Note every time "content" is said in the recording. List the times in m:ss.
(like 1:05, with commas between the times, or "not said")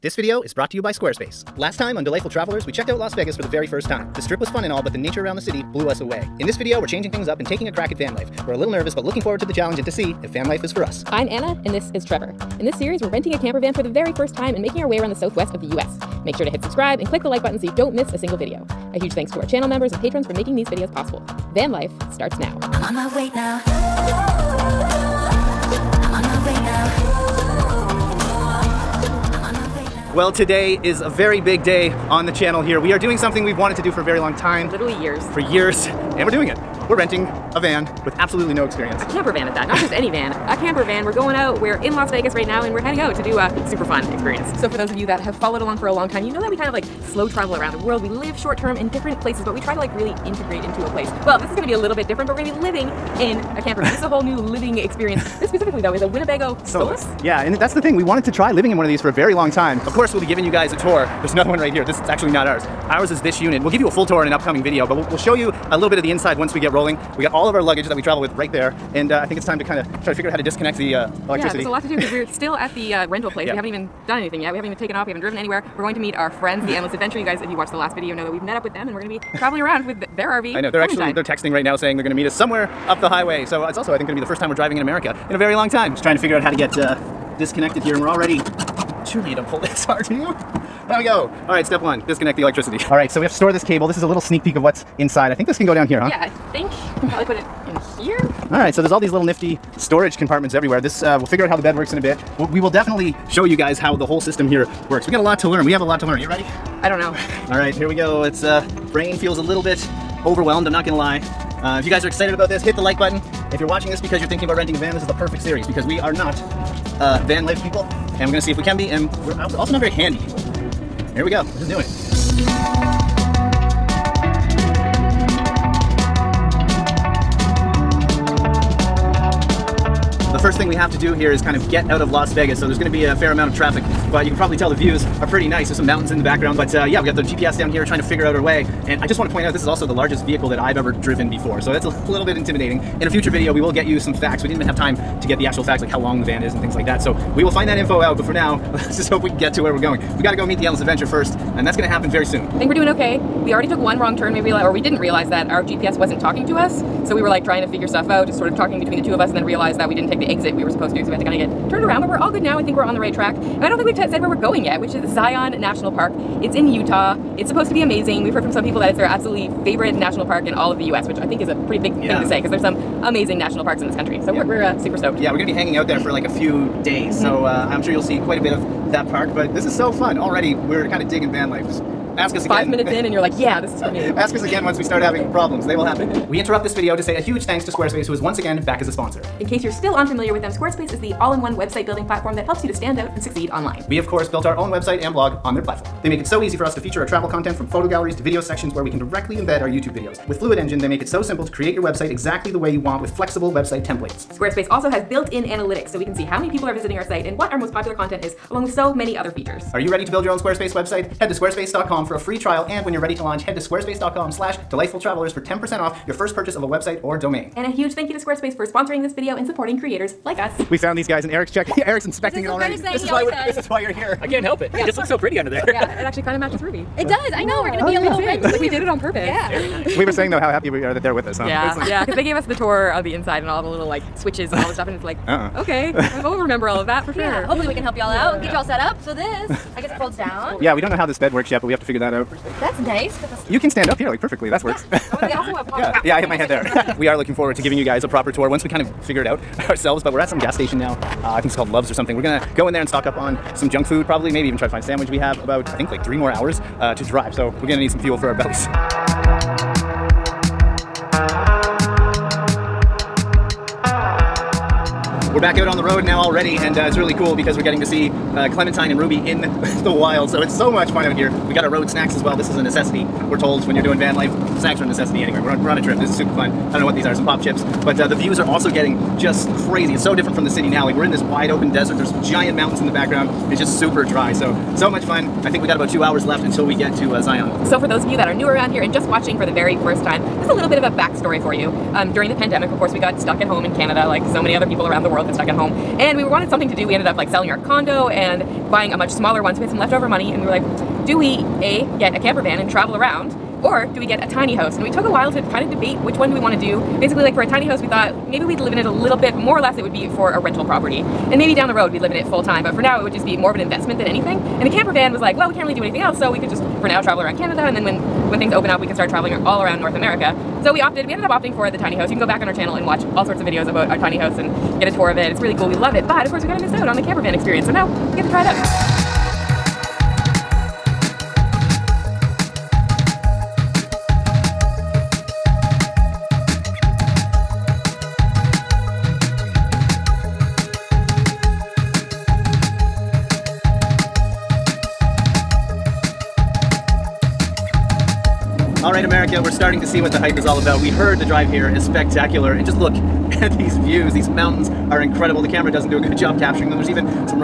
3:17, 3:27.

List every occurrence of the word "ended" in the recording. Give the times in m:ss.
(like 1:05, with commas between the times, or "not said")
4:56, 5:21.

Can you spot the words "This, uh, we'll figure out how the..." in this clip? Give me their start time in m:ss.
1:40.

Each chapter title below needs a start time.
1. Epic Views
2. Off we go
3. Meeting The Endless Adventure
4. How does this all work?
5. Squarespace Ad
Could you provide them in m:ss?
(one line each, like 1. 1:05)
1. 5:27
2. 1:47
3. 3:40
4. 1:25
5. 3:05.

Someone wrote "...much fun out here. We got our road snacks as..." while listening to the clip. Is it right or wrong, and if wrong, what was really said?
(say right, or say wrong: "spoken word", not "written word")
right.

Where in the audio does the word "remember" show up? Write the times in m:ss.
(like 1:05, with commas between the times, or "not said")
3:56.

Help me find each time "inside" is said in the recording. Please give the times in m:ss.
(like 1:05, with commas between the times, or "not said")
1:06, 1:34, 3:53.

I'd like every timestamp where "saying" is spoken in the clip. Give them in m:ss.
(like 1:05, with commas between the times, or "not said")
1:21, 3:50.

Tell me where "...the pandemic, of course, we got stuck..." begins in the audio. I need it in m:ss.
4:52.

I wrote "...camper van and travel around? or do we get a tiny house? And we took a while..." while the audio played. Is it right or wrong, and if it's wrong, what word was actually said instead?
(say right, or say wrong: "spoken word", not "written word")
right.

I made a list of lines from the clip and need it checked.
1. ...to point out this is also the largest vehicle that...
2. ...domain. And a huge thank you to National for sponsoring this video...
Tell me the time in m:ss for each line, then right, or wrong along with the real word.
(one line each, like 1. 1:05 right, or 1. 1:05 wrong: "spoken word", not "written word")
1. 2:19 right
2. 3:37 wrong: "Squarespace", not "National".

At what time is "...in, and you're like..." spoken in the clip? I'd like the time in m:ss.
3:02.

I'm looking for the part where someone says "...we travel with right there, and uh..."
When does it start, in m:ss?
1:07.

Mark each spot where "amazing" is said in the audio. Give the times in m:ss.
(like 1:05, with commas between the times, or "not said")
2:47, 2:53.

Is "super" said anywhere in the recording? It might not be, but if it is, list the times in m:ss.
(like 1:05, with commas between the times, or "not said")
0:43, 2:54, 4:36, 4:43.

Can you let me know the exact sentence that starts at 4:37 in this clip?
But uh, the views are also getting just crazy.